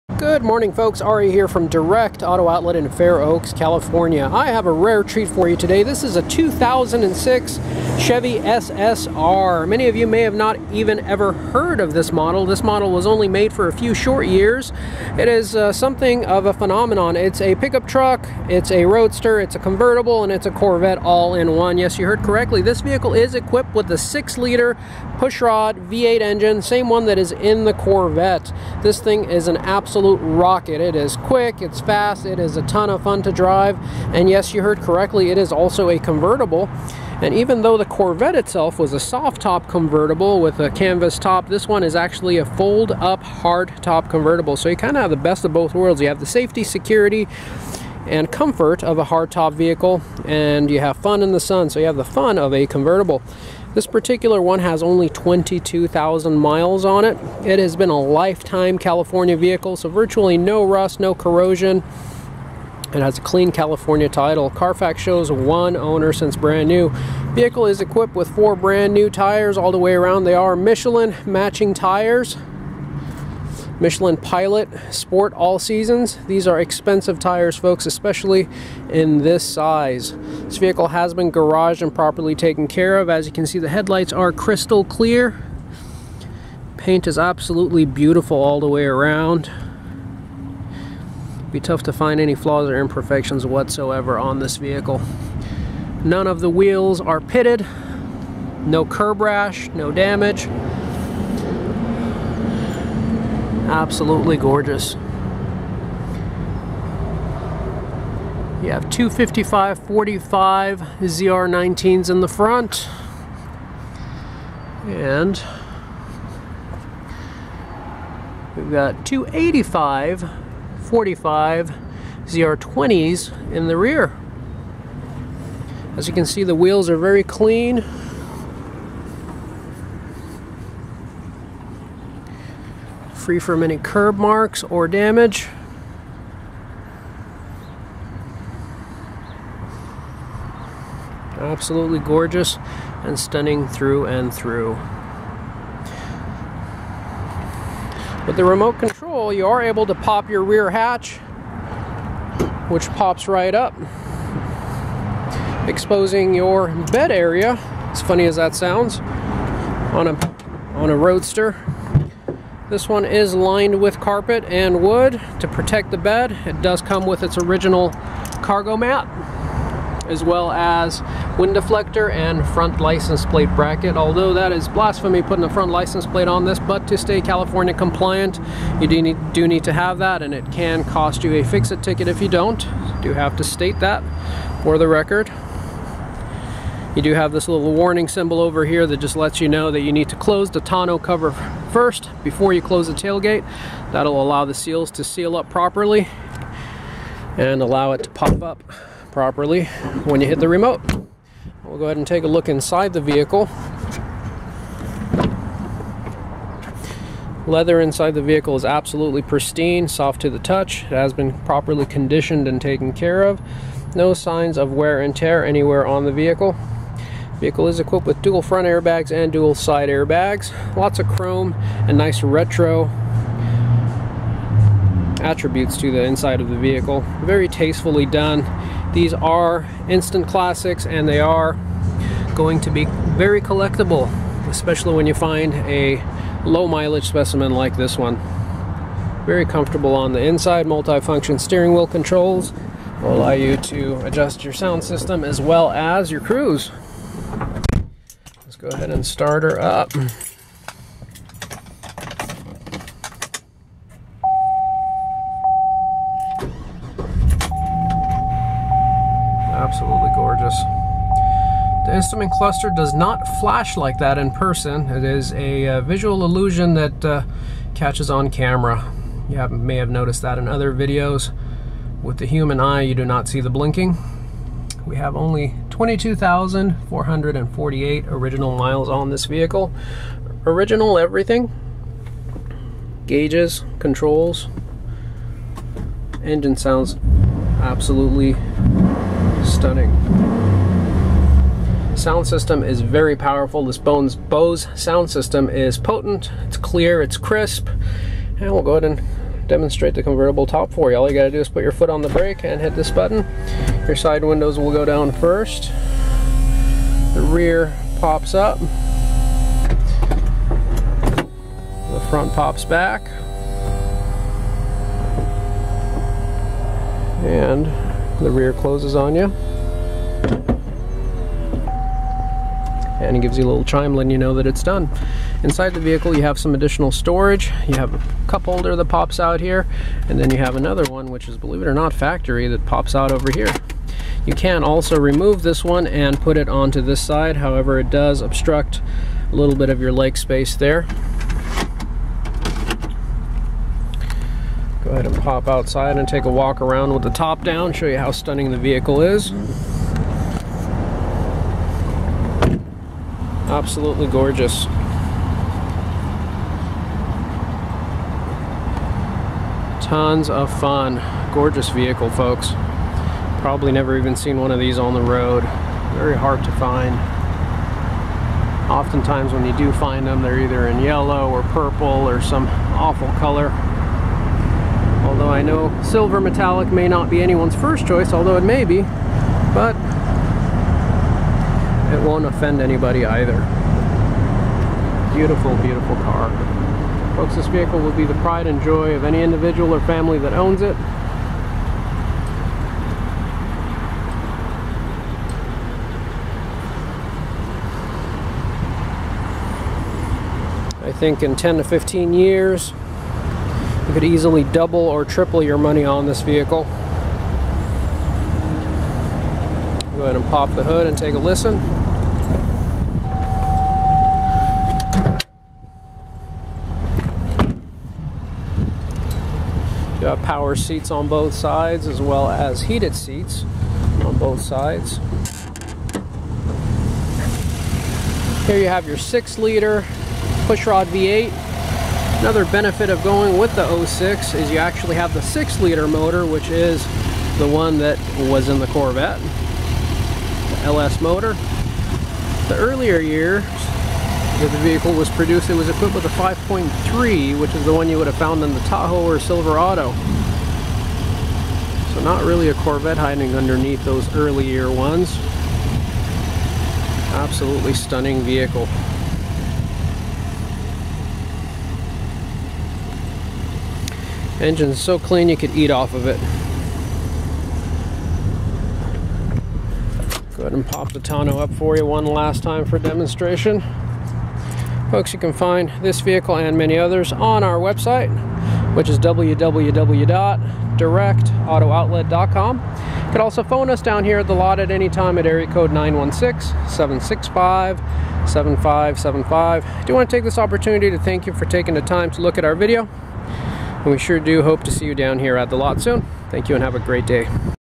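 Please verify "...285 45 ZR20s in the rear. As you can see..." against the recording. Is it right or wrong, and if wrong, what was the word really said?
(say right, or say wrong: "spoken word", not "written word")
right.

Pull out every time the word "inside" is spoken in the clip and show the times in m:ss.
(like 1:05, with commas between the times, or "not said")
3:22, 3:27, 3:46, 4:00, 5:25.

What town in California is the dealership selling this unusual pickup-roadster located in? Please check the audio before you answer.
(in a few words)
Fair Oaks.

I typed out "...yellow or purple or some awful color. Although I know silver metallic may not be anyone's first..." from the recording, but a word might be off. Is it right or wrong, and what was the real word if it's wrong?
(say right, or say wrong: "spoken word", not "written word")
right.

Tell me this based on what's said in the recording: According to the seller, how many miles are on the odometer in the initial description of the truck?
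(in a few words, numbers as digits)
22,000.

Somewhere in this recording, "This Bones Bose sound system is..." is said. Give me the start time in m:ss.
4:53.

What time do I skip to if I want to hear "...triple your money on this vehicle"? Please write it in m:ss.
6:45.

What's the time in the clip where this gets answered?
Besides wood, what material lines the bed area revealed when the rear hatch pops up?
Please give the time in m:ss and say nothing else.
2:43.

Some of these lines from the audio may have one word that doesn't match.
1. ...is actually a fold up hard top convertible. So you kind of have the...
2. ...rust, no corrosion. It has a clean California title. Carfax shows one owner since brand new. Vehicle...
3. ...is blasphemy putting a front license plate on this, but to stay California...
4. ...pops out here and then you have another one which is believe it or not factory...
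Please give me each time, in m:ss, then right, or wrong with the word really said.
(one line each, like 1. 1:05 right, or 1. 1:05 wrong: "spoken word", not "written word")
1. 0:41 right
2. 1:00 right
3. 2:54 right
4. 5:28 right.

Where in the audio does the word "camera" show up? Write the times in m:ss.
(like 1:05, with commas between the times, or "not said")
4:28.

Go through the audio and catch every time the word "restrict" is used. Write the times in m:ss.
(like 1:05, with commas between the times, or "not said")
not said.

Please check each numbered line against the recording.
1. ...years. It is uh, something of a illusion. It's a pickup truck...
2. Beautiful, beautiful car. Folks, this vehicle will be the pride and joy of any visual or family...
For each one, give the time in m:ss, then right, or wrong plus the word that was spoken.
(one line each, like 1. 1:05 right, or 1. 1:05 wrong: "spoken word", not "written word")
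1. 0:14 wrong: "phenomenon", not "illusion"
2. 6:25 wrong: "individual", not "visual".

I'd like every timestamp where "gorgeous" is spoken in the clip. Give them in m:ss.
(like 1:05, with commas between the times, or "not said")
1:44, 2:21, 4:20, 5:54, 6:01.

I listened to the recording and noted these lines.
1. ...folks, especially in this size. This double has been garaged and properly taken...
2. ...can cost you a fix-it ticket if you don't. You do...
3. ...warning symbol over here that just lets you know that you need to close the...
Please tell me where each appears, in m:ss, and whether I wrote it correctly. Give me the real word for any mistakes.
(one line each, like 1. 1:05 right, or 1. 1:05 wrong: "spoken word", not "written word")
1. 1:17 wrong: "vehicle", not "double"
2. 3:00 right
3. 3:07 right.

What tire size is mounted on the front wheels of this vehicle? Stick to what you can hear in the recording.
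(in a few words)
255 45 ZR19.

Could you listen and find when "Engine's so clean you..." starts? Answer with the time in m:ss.
7:44.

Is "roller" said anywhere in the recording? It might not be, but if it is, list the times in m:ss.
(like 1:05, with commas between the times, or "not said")
not said.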